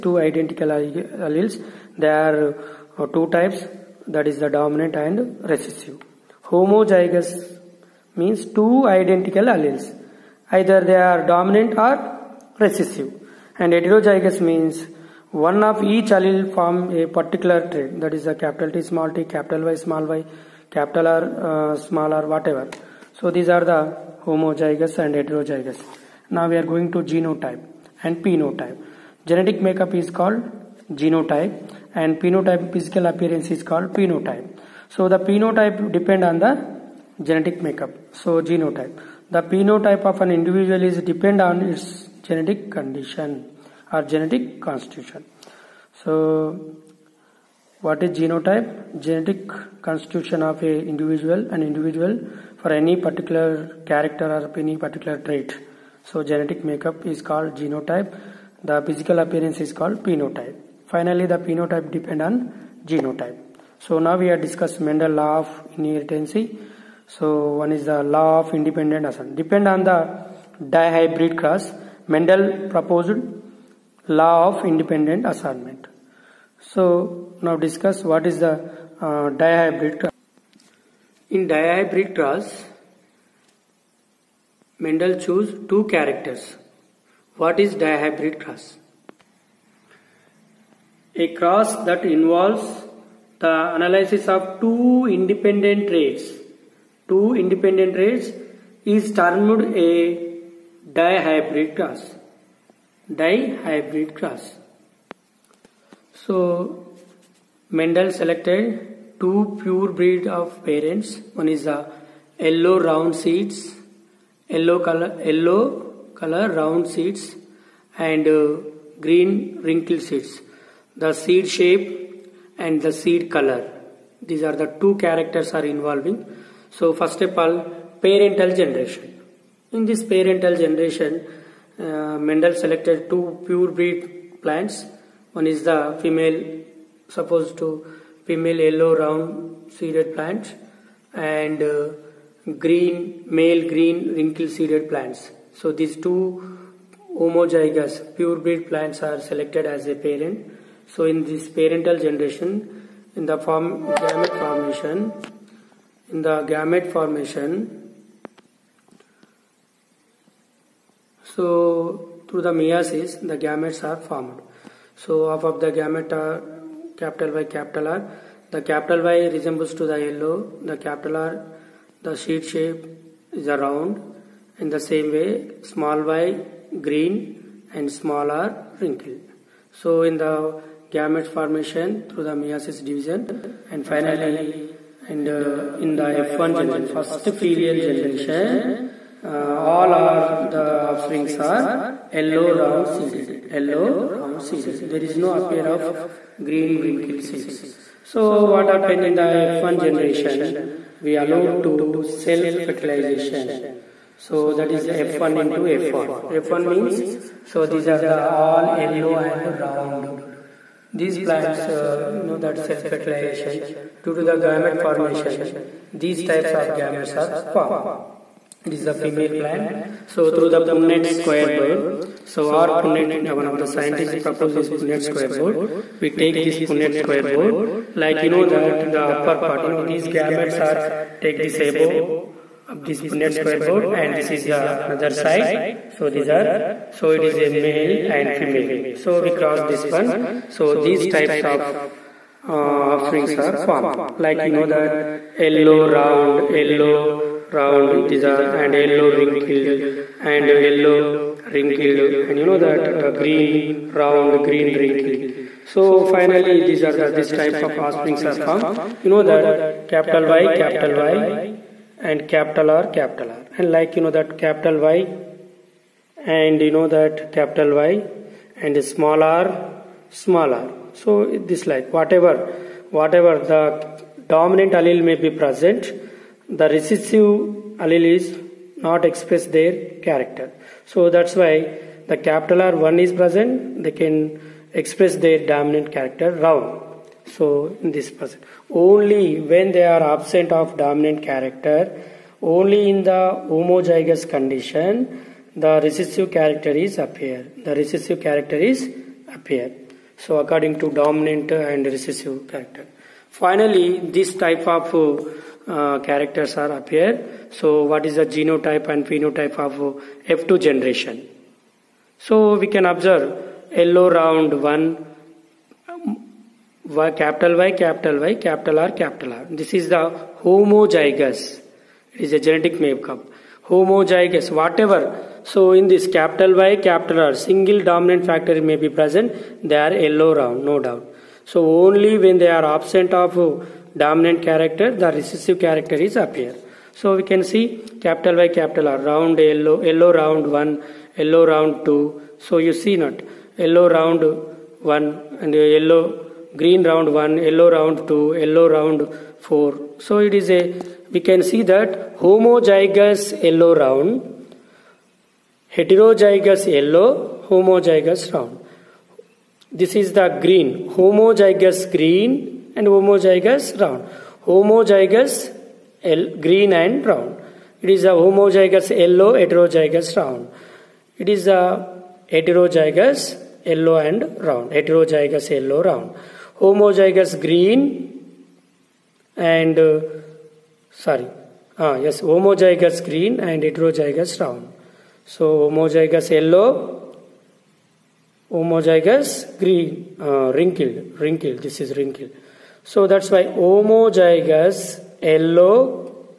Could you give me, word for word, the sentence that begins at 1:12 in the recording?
Mendel proposed law of independent assortment.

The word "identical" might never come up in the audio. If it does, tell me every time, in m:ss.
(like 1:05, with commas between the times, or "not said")
0:00, 0:08.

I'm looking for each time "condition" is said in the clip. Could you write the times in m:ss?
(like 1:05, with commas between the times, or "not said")
0:42, 4:54.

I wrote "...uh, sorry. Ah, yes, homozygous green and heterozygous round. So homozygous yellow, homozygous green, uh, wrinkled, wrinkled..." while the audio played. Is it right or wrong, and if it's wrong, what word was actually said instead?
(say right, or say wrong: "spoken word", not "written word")
right.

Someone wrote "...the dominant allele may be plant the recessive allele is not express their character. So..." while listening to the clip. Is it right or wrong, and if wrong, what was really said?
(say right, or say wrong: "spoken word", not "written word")
wrong: "present", not "plant".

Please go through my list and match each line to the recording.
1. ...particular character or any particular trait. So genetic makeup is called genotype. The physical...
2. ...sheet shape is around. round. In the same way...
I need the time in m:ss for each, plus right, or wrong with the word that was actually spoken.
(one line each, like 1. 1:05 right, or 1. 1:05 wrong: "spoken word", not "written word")
1. 0:52 right
2. 2:52 right.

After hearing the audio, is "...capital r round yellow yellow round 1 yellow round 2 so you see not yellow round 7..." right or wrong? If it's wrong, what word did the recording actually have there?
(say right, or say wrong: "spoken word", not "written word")
wrong: "1", not "7".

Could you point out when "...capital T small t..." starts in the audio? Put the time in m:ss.
0:18.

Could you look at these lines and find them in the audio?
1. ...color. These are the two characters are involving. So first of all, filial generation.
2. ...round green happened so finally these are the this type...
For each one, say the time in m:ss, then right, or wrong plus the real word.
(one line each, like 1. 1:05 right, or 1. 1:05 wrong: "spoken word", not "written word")
1. 2:03 wrong: "parental", not "filial"
2. 4:13 wrong: "wrinkled", not "happened".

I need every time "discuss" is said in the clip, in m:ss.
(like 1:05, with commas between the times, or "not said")
1:04, 1:17.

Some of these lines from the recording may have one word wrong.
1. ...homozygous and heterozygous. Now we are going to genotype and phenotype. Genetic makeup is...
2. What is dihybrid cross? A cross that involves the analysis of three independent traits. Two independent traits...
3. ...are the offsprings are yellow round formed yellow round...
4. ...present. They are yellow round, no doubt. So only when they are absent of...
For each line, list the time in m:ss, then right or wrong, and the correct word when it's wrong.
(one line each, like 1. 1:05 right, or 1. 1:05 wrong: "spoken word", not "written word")
1. 0:24 right
2. 1:27 wrong: "two", not "three"
3. 3:09 wrong: "seeded", not "formed"
4. 5:28 right.